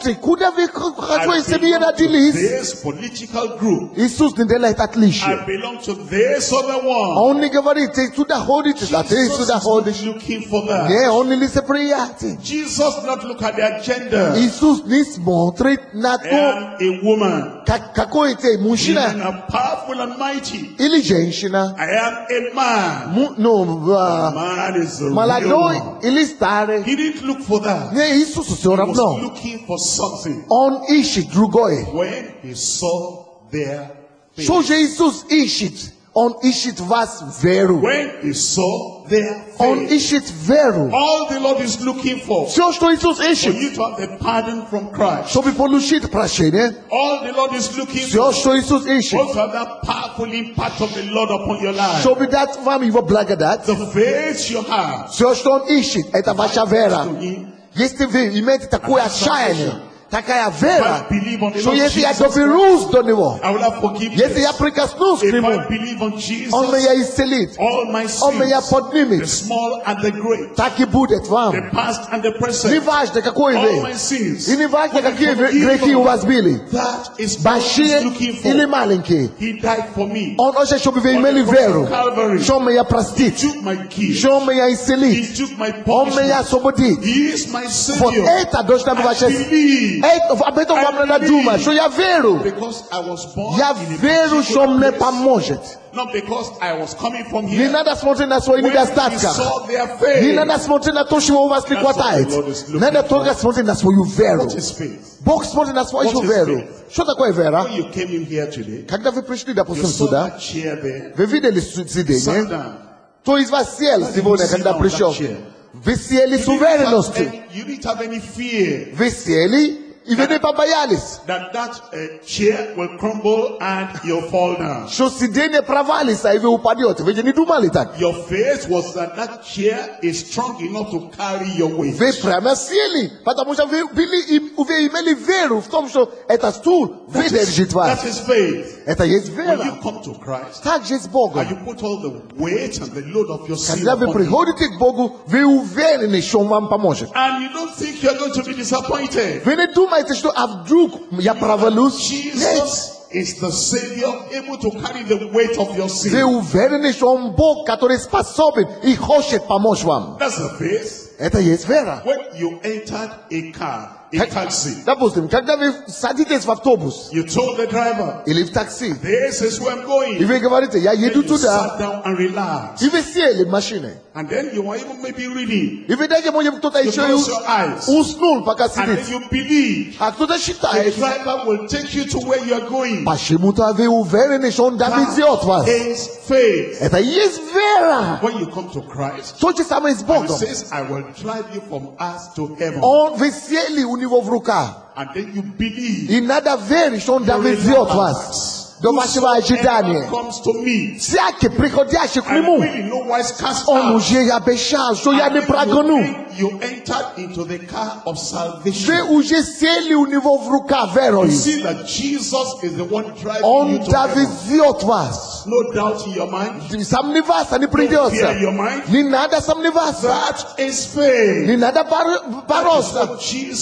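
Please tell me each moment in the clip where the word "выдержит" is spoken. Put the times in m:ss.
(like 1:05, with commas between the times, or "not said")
2:17.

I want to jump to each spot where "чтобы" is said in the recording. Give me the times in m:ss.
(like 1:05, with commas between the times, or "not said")
0:45, 0:52, 1:20.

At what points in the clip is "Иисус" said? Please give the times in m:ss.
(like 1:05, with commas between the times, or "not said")
0:03, 0:14, 0:35, 0:42, 0:48.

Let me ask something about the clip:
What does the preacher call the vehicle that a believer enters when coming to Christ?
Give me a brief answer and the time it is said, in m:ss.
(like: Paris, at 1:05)
the car of salvation, at 3:27.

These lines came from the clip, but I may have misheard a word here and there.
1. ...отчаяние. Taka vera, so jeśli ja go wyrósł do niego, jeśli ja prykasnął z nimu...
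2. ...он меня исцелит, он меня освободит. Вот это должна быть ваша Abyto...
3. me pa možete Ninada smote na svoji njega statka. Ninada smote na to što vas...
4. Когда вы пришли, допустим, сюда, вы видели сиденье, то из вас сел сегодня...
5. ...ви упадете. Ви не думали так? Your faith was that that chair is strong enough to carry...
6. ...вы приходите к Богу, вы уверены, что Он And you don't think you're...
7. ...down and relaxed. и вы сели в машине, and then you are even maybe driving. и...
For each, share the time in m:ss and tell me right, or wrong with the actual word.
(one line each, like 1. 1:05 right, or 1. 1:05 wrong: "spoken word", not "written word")
1. 0:59 right
2. 1:24 right
3. 1:37 right
4. 1:48 right
5. 2:06 right
6. 2:23 right
7. 2:51 wrong: "reading", not "driving".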